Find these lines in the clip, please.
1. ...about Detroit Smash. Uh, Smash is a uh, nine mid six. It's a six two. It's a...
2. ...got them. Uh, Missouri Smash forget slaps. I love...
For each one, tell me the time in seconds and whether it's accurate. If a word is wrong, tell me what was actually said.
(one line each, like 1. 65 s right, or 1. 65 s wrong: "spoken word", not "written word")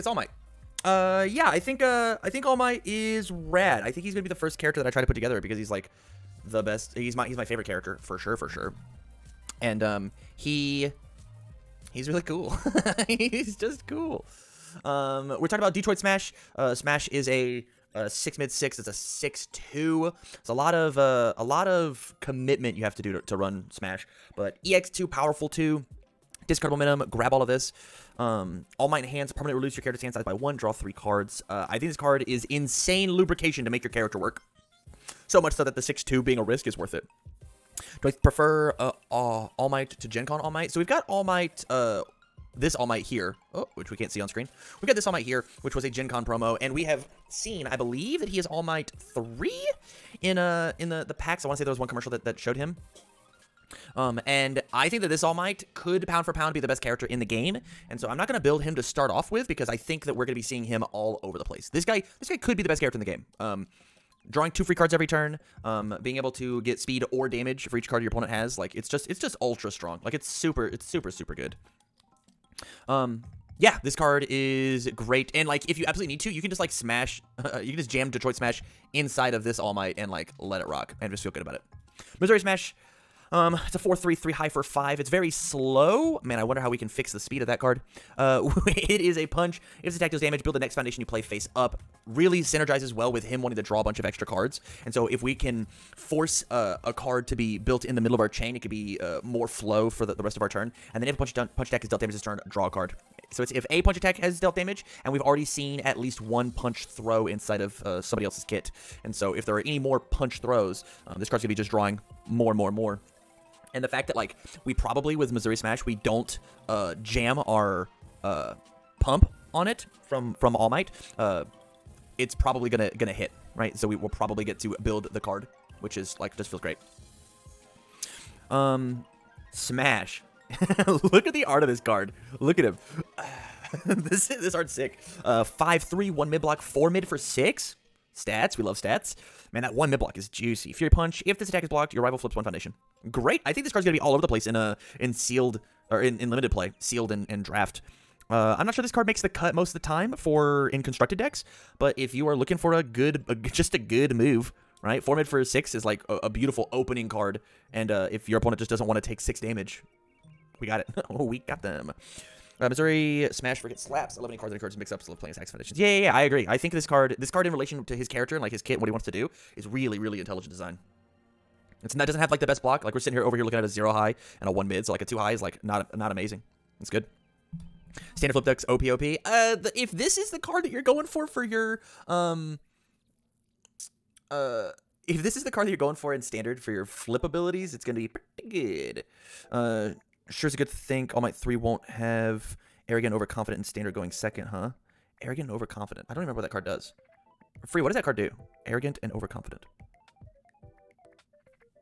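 1. 15 s wrong: "six", not "nine"
2. 161 s right.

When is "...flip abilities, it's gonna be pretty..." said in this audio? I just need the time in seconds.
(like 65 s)
186 s.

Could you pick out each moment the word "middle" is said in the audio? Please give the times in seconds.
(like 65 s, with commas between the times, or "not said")
97 s.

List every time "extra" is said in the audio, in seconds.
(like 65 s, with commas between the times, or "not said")
94 s.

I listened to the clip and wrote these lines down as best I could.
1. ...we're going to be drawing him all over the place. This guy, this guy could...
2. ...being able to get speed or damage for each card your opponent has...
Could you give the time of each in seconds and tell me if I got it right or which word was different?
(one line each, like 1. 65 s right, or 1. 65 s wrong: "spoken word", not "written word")
1. 60 s wrong: "seeing", not "drawing"
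2. 66 s right.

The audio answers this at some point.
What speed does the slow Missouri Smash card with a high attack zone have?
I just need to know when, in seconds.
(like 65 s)
84 s.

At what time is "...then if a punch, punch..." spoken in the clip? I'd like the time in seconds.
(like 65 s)
101 s.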